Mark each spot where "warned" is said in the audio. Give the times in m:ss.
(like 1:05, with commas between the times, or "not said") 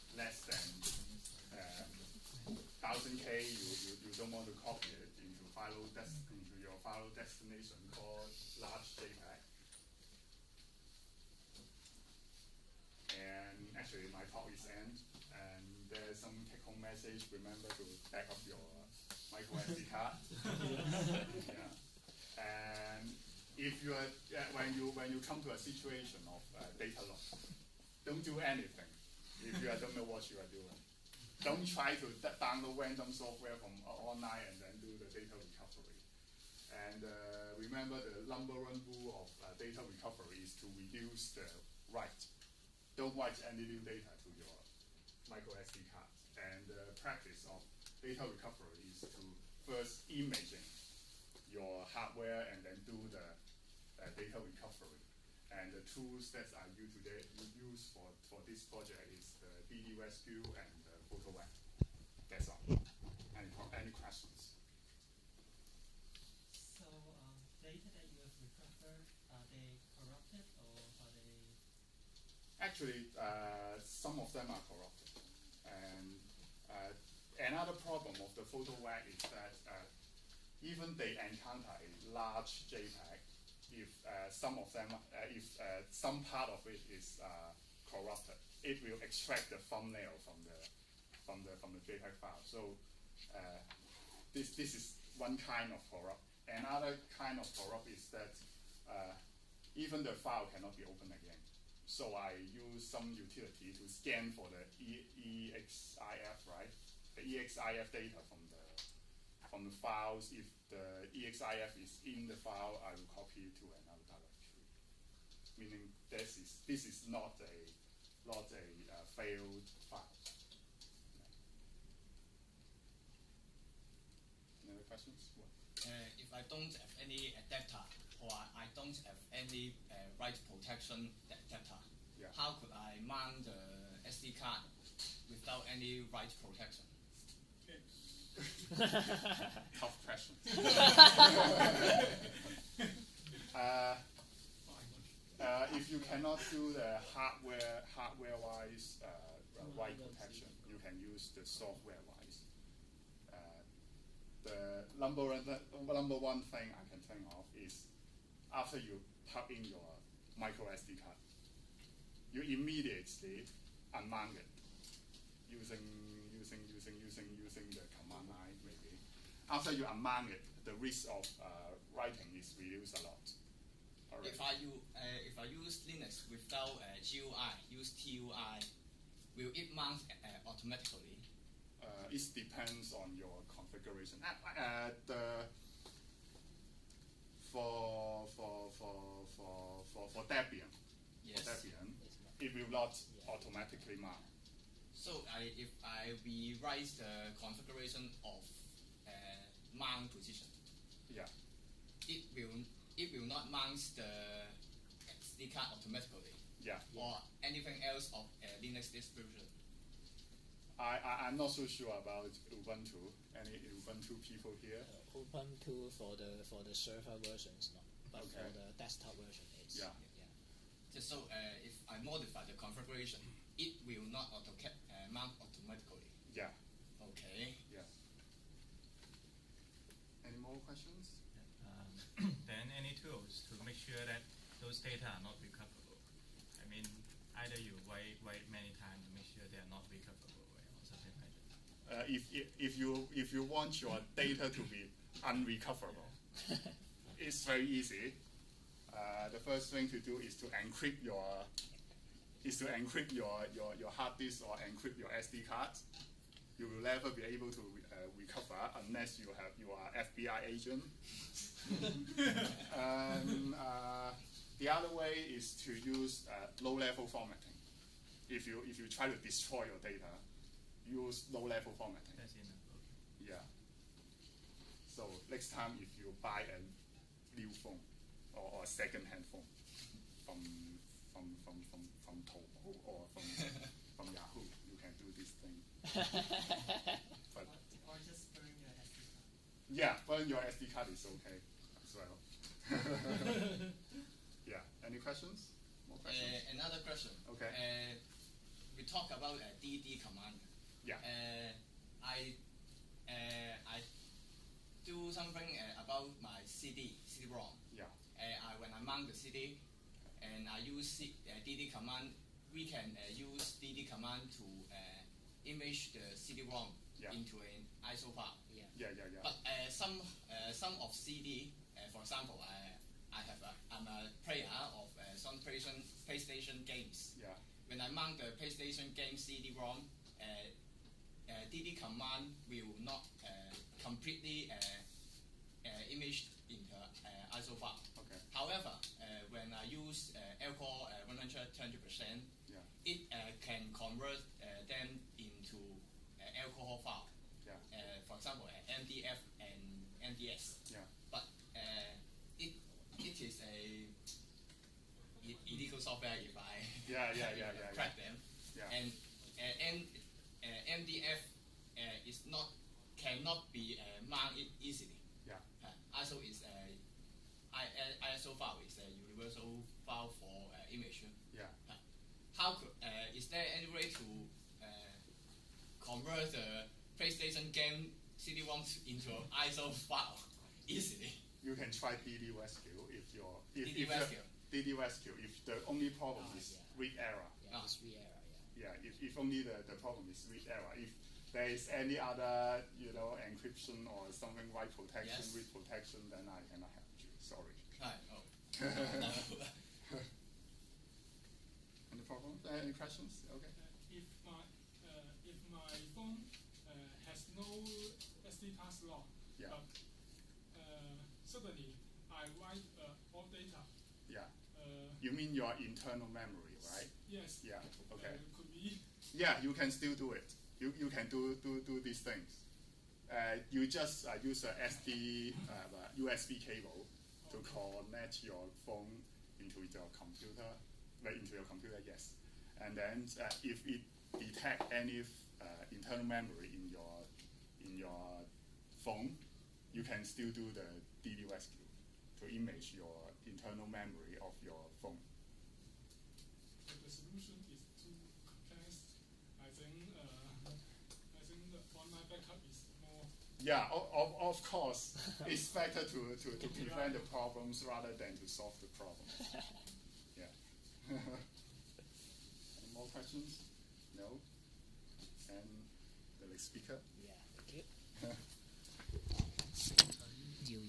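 not said.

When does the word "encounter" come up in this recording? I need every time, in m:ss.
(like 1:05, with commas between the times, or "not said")
1:21.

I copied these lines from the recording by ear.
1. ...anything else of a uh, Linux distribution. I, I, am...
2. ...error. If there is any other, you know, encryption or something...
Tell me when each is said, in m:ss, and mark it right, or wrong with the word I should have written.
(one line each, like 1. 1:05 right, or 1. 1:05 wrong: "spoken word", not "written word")
1. 3:27 right
2. 6:30 right.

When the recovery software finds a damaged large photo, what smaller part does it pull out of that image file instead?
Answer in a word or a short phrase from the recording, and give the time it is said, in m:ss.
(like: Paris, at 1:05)
the thumbnail, at 1:29.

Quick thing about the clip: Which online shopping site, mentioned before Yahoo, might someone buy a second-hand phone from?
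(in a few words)
Taobao.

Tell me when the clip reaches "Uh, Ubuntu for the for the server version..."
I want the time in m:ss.
3:34.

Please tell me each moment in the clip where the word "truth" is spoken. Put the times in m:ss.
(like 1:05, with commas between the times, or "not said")
not said.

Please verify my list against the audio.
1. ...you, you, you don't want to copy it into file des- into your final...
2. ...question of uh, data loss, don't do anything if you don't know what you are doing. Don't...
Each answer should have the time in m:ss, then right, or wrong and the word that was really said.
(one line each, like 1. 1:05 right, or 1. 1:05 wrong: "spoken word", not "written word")
1. 0:03 right
2. 0:25 wrong: "situation", not "question".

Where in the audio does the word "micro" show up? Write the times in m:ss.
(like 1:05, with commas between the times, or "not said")
0:19, 0:45, 2:40.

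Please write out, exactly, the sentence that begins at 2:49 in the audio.
After you unmount it, the risk of uh, writing is reduced a lot.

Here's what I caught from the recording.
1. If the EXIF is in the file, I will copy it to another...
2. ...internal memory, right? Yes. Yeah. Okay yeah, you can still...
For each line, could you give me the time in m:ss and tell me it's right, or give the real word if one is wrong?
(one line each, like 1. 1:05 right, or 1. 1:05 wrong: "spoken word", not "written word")
1. 1:50 right
2. 6:55 right.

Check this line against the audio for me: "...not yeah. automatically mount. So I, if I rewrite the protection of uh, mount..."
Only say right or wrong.
wrong.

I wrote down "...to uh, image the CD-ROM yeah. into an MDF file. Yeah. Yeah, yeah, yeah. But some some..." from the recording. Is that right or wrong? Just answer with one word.
wrong.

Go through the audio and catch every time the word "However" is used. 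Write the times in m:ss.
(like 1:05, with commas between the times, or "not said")
5:38.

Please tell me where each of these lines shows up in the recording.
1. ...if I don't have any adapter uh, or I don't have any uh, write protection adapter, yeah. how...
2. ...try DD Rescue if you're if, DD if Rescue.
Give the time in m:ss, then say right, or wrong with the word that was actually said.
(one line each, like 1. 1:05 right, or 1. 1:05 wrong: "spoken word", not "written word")
1. 2:06 right
2. 6:21 right.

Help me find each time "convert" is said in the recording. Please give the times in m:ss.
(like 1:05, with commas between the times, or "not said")
5:43, 6:15.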